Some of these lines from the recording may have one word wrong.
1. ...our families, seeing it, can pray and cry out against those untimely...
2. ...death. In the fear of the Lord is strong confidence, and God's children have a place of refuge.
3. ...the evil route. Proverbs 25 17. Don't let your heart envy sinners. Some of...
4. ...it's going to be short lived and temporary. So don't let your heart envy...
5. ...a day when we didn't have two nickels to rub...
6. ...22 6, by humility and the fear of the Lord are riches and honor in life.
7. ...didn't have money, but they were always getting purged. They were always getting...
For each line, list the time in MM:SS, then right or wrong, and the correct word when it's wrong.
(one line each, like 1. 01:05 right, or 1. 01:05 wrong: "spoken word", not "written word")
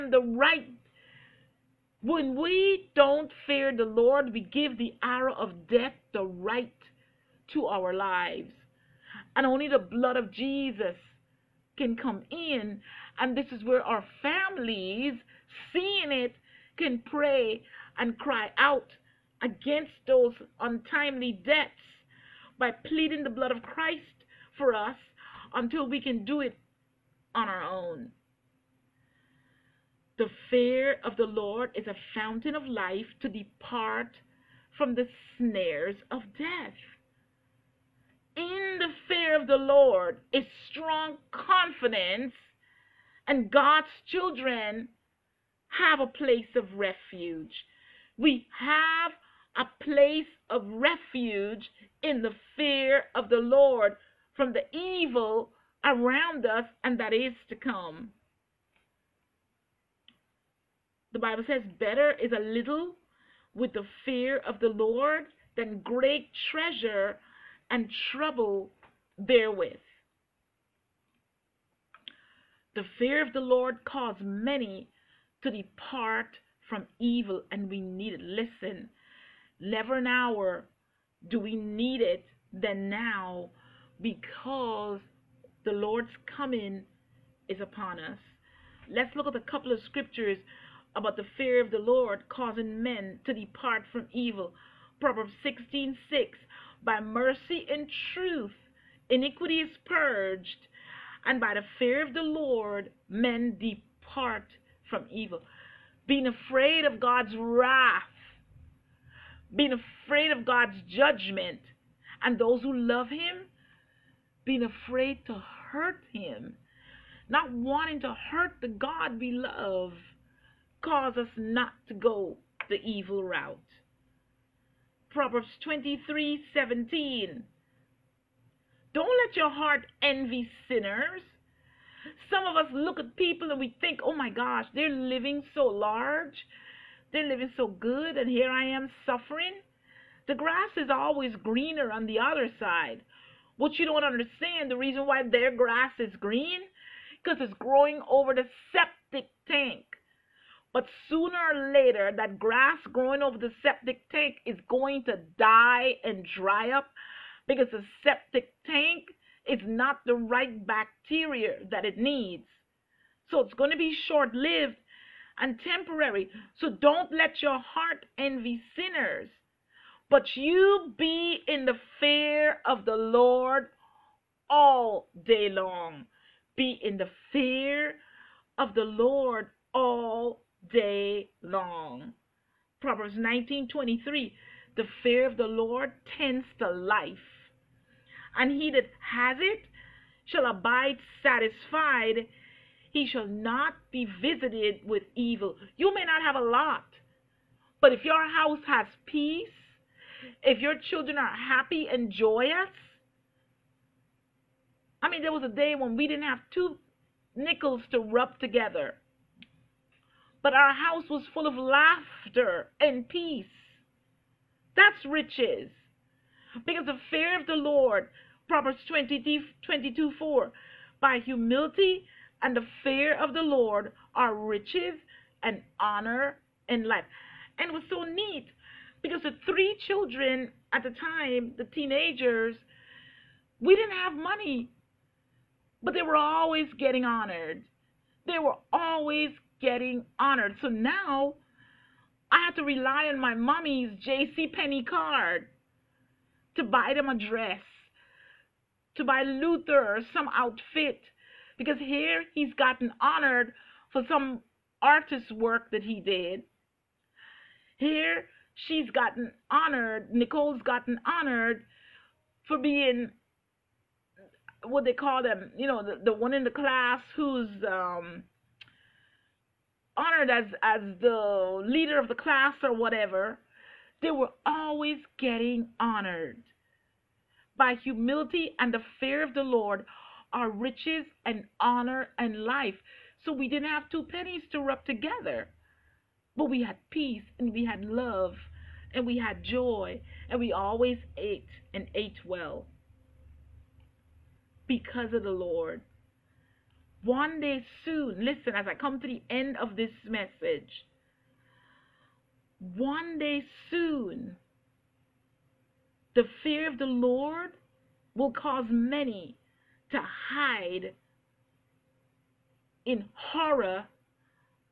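1. 00:13 right
2. 00:36 right
3. 02:02 wrong: "23", not "25"
4. 02:43 right
5. 03:25 right
6. 03:39 wrong: "4", not "6"
7. 03:53 wrong: "honored", not "purged".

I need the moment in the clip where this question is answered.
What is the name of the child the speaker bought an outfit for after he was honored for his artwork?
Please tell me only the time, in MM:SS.
04:09.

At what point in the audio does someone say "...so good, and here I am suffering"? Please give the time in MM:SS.
02:17.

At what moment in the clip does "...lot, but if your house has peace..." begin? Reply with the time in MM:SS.
03:16.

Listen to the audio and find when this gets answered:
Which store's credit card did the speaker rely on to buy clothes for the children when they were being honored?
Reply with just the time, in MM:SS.
04:04.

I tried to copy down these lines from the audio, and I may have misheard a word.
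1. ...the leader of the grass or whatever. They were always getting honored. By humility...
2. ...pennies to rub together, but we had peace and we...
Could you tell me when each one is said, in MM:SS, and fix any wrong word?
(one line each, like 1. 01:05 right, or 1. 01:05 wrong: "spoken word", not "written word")
1. 04:31 wrong: "class", not "grass"
2. 04:44 right.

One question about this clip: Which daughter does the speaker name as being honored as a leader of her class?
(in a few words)
Nicole.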